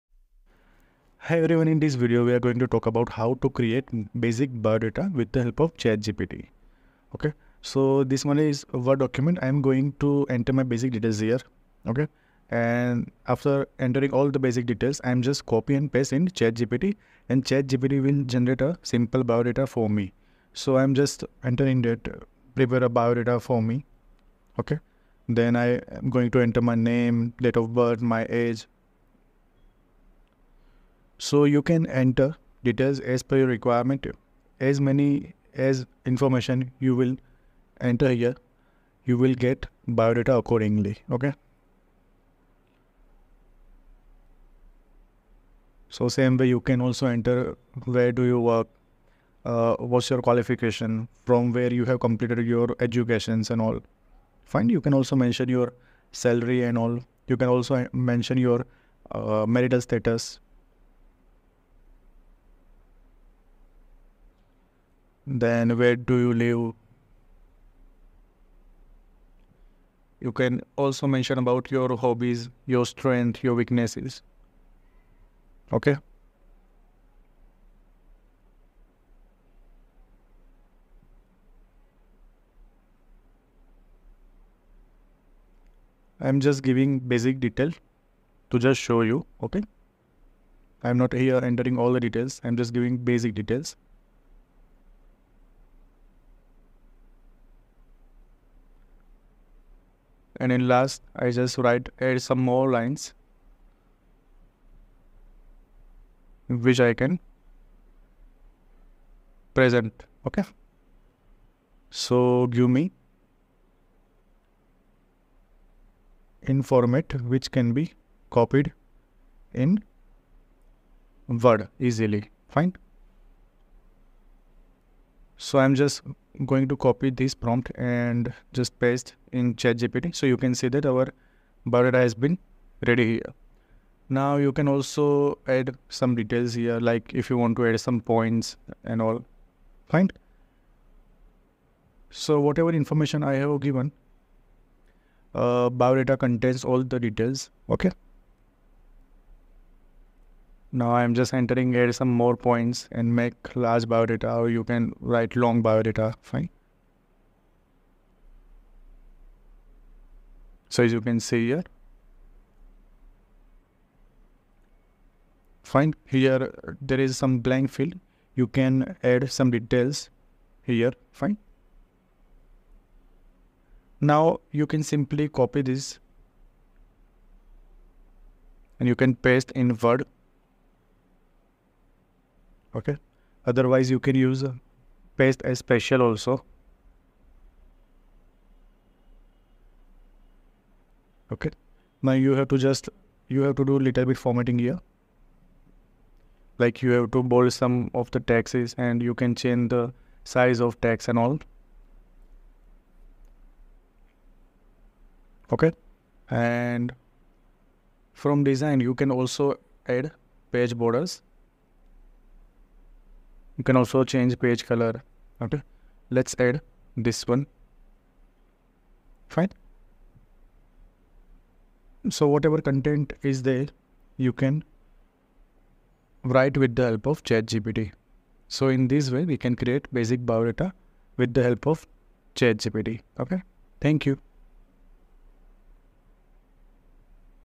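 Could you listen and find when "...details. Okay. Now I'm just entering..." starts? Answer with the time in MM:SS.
02:26.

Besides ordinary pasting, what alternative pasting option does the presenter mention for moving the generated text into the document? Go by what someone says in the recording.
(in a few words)
paste as special.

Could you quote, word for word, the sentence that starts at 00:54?
Fine, you can also mention your salary and all.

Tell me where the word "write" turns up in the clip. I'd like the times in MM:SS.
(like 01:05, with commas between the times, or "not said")
01:41, 02:35, 03:46.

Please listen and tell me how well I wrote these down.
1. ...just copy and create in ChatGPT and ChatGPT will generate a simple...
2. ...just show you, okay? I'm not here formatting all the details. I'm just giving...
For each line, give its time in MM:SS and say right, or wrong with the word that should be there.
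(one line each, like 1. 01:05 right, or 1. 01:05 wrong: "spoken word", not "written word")
1. 00:15 wrong: "paste", not "create"
2. 01:28 wrong: "entering", not "formatting".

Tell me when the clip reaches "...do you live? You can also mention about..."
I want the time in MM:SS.
01:05.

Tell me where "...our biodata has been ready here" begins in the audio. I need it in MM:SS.
02:10.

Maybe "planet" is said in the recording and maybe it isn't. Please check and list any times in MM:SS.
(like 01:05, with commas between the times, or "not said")
not said.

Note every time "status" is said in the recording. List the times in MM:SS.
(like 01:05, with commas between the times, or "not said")
00:59.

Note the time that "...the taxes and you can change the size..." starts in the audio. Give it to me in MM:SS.
03:18.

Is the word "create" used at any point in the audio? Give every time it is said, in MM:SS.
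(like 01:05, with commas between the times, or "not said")
00:03, 03:49.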